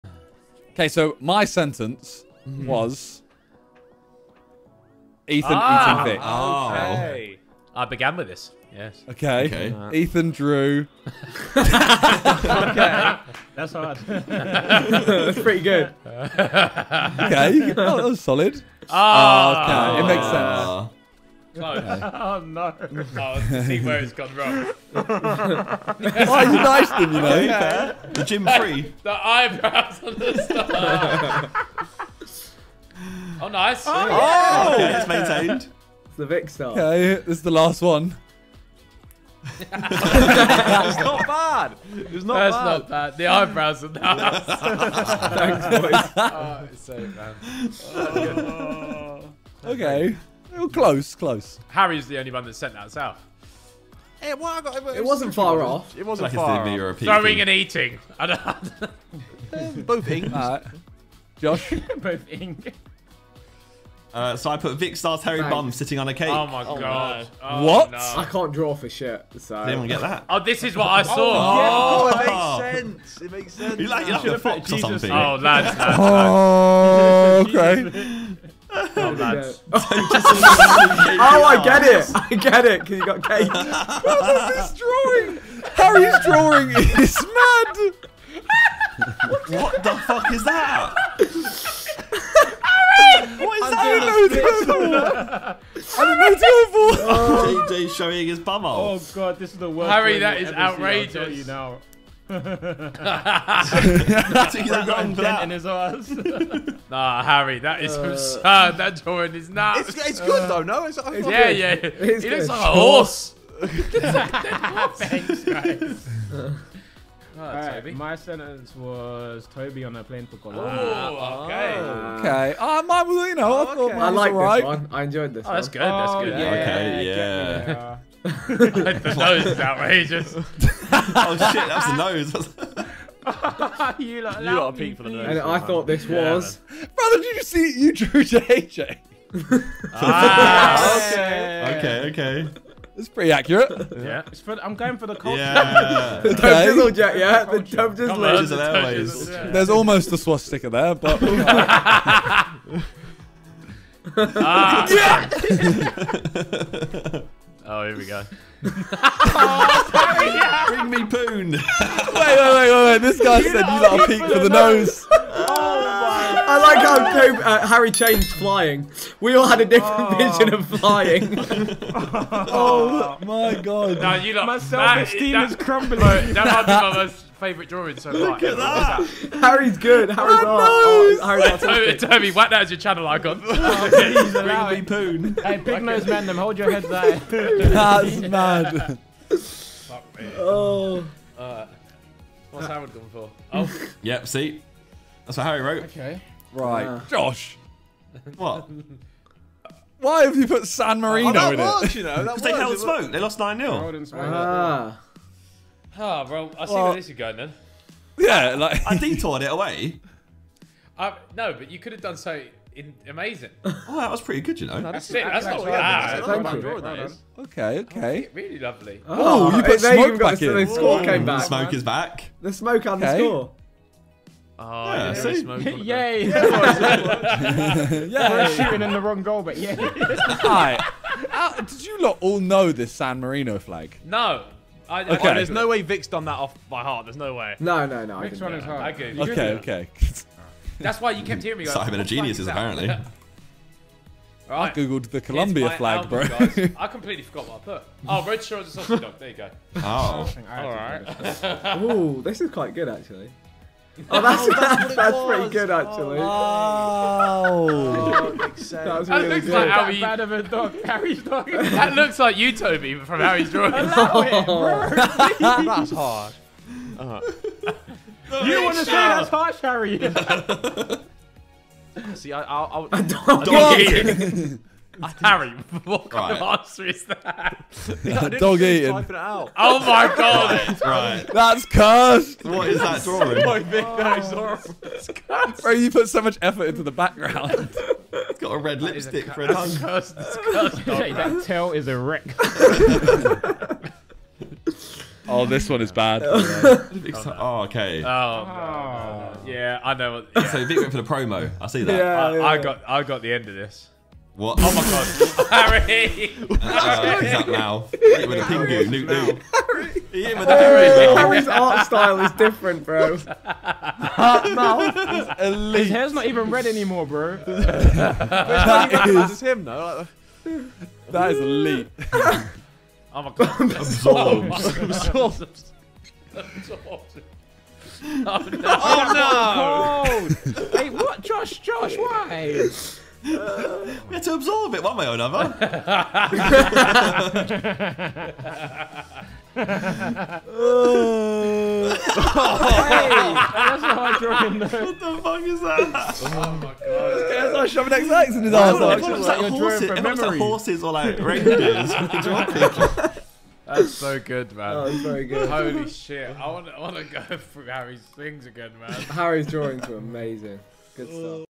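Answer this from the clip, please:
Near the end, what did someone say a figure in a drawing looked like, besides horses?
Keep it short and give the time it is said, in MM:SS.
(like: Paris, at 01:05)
Reindeers, at 05:51.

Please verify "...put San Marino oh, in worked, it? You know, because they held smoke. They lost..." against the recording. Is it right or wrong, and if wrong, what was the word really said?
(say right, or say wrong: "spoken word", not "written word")
right.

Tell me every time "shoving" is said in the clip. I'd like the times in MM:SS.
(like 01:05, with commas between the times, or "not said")
05:47.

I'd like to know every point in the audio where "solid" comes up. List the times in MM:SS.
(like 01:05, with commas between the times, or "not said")
00:18.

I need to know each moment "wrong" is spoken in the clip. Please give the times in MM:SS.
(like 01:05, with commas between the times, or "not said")
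00:24, 03:49.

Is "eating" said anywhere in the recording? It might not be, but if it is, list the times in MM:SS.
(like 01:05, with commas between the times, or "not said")
00:06, 00:57, 04:38.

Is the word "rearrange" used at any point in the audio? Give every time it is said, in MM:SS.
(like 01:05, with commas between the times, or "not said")
not said.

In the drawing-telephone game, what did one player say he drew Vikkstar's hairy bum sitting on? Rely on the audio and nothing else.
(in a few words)
A cake.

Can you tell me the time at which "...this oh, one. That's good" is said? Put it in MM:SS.
02:05.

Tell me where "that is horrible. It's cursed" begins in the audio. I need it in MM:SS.
04:43.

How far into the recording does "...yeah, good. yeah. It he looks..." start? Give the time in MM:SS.
01:51.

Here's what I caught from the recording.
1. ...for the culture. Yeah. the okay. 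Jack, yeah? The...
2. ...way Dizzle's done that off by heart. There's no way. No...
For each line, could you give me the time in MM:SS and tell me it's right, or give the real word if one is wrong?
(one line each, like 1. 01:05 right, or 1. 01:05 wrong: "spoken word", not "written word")
1. 02:24 right
2. 03:55 wrong: "Vic", not "Dizzle".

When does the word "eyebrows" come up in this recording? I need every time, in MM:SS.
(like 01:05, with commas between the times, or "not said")
00:29, 00:43.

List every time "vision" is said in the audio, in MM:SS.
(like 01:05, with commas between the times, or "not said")
02:50.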